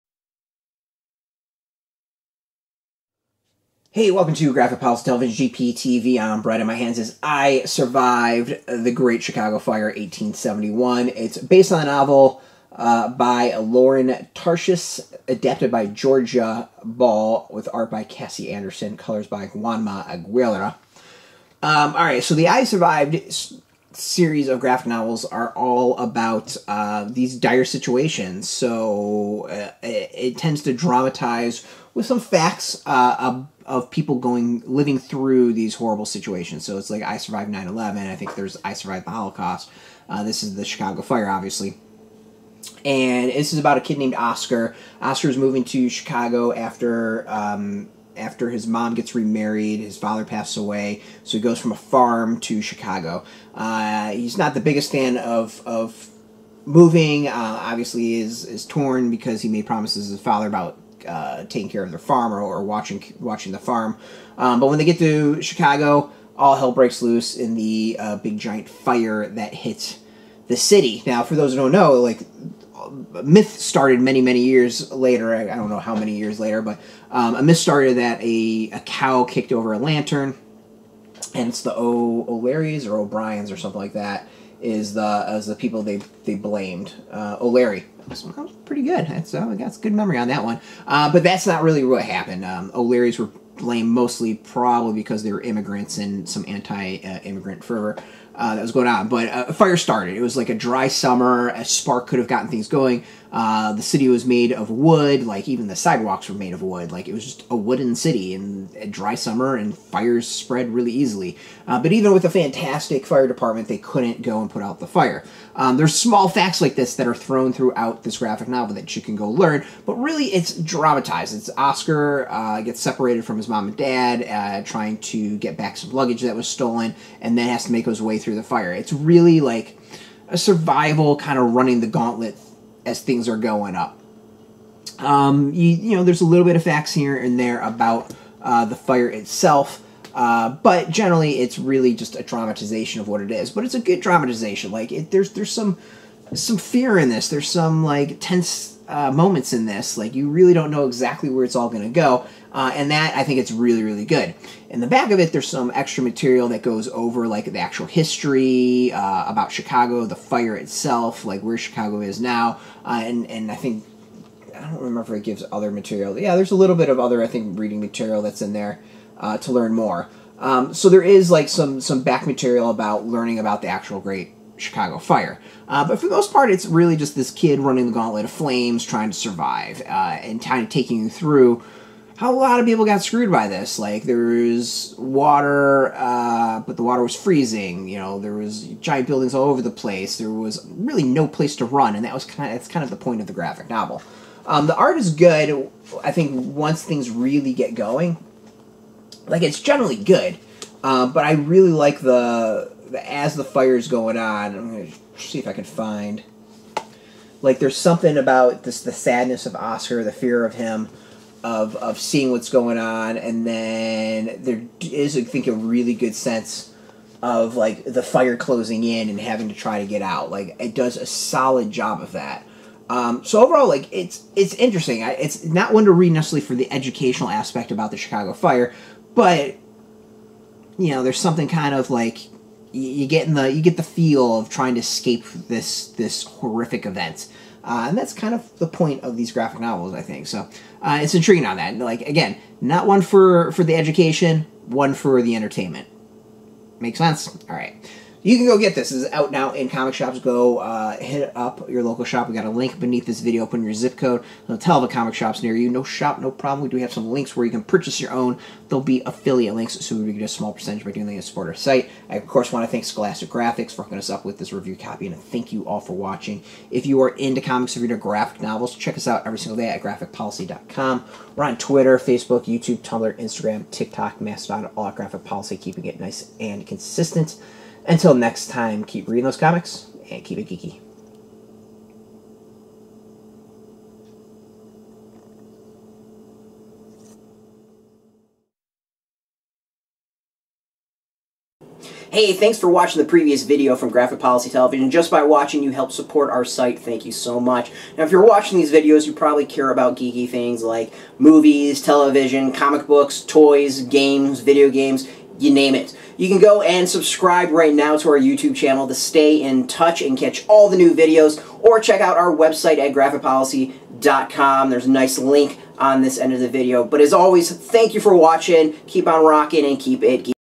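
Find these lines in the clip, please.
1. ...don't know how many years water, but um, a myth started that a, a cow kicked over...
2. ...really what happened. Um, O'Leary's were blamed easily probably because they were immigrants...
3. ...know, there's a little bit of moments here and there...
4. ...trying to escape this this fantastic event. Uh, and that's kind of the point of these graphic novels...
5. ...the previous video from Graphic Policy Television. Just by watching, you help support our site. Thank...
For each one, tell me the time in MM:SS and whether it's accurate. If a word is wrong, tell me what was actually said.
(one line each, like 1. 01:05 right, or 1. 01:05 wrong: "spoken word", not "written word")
1. 01:15 wrong: "later", not "water"
2. 01:31 wrong: "mostly", not "easily"
3. 02:15 wrong: "facts", not "moments"
4. 03:54 wrong: "horrific", not "fantastic"
5. 04:53 right.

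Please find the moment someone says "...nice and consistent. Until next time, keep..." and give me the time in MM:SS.
04:35.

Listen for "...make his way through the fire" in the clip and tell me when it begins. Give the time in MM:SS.
02:07.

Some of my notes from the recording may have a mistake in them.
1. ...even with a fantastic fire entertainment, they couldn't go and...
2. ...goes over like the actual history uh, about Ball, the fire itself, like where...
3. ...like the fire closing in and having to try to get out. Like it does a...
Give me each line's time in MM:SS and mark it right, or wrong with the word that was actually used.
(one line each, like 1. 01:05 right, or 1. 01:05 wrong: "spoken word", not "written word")
1. 01:51 wrong: "department", not "entertainment"
2. 02:36 wrong: "Chicago", not "Ball"
3. 03:37 right.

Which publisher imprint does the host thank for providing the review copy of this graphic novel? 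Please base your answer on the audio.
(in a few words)
Scholastic Graphix.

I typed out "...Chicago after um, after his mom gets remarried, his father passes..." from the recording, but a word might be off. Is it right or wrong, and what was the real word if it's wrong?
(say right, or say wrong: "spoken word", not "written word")
right.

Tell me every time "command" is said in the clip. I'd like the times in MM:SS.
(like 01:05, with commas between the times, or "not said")
not said.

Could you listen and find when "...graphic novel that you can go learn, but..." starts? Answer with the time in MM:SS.
01:58.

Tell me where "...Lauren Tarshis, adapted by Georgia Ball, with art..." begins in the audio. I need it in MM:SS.
00:13.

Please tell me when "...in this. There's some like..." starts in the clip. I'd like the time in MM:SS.
02:26.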